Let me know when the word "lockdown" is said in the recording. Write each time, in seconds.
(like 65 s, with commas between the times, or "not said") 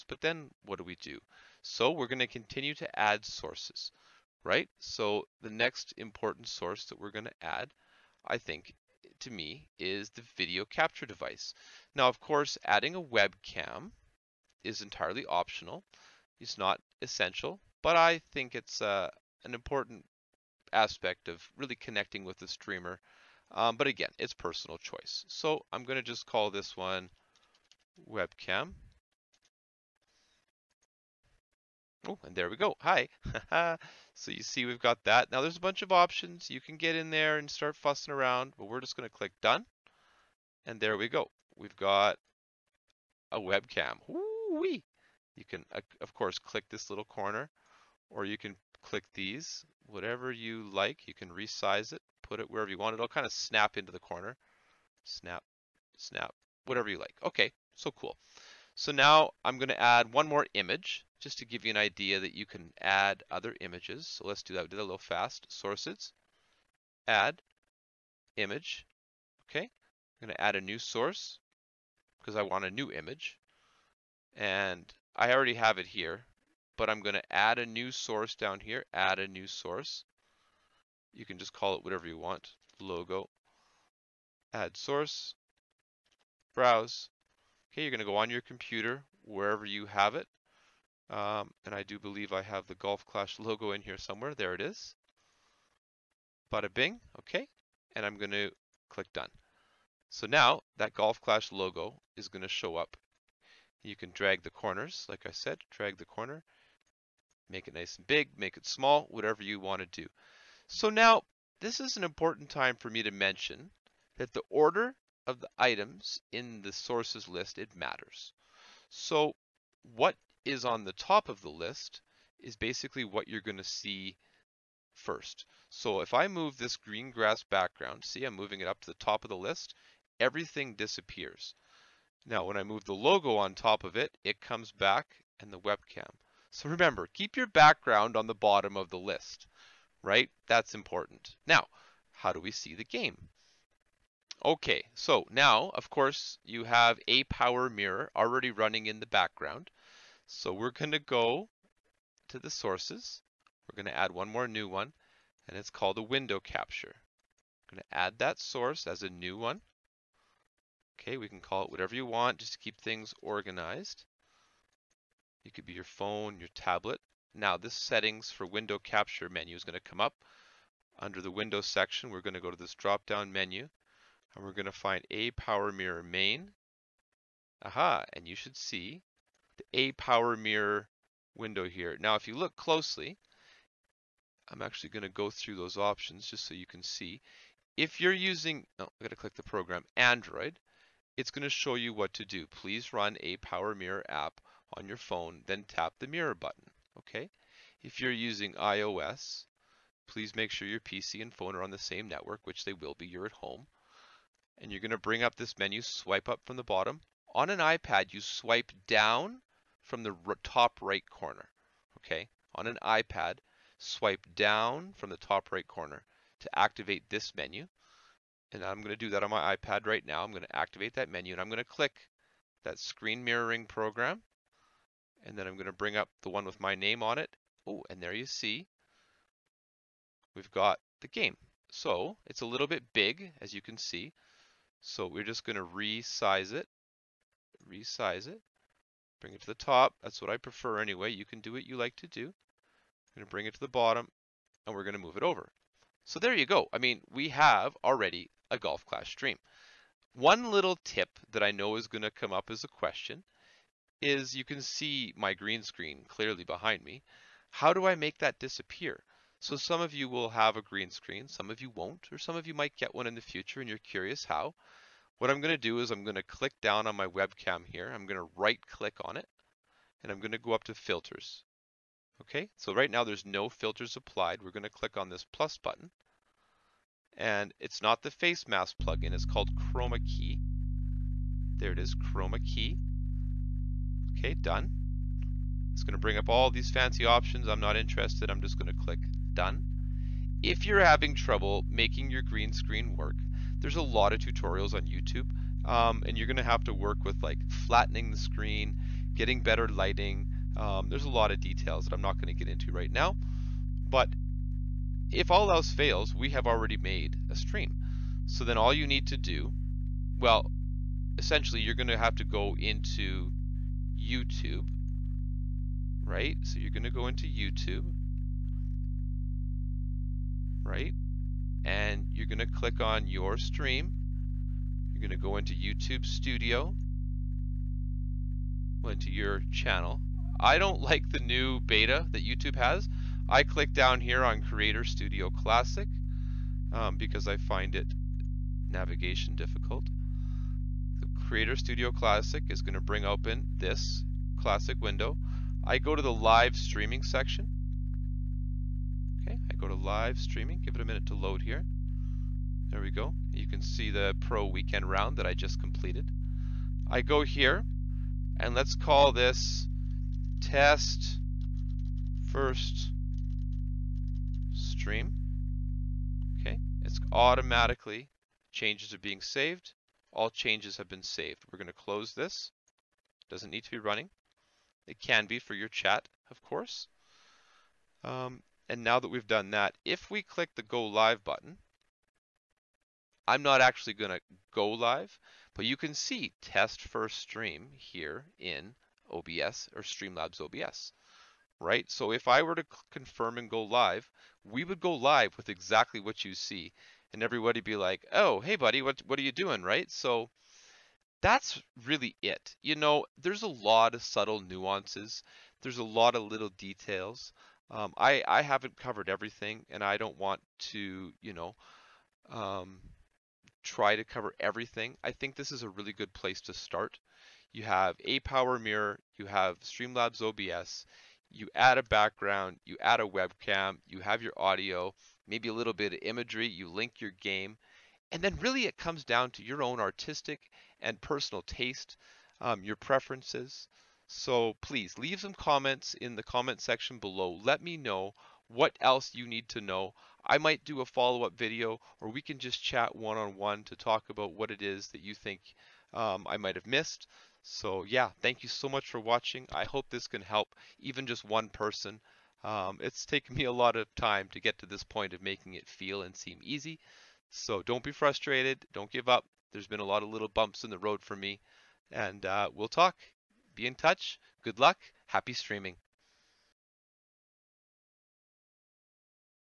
not said.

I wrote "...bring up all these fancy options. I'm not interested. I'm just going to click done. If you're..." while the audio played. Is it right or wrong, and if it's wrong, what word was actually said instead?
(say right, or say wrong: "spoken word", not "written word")
right.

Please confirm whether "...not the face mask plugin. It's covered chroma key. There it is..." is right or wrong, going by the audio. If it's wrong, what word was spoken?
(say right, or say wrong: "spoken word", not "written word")
wrong: "called", not "covered".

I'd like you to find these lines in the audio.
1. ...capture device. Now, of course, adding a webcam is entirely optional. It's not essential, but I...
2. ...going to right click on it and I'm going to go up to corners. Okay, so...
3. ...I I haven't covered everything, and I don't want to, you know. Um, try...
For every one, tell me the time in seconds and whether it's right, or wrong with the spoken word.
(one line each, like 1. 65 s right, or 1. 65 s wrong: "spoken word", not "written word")
1. 10 s right
2. 268 s wrong: "filters", not "corners"
3. 407 s right.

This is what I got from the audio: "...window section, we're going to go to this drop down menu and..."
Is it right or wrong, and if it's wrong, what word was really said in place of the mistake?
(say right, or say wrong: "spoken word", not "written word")
right.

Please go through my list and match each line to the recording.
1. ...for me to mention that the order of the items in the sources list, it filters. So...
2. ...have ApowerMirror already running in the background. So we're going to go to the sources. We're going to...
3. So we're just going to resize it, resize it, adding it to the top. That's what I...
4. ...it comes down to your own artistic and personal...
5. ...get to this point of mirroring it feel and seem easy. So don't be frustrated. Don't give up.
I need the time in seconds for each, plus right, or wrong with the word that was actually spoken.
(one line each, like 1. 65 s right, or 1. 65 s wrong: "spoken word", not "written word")
1. 112 s wrong: "matters", not "filters"
2. 146 s right
3. 234 s wrong: "bring", not "adding"
4. 428 s right
5. 454 s wrong: "making", not "mirroring".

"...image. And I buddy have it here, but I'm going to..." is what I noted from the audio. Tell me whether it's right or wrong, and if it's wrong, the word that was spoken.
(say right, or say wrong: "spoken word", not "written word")
wrong: "already", not "buddy".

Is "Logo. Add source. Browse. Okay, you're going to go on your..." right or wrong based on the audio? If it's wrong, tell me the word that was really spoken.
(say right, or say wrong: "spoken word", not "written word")
right.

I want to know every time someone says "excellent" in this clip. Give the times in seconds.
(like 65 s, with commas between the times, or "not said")
not said.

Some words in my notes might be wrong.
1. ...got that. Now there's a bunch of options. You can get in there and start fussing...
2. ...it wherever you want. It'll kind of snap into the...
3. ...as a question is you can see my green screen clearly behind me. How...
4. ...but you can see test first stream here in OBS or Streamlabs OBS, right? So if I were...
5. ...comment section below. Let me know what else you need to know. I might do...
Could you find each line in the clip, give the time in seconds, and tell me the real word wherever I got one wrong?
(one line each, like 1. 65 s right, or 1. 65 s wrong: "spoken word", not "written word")
1. 34 s right
2. 52 s right
3. 252 s right
4. 385 s right
5. 436 s right.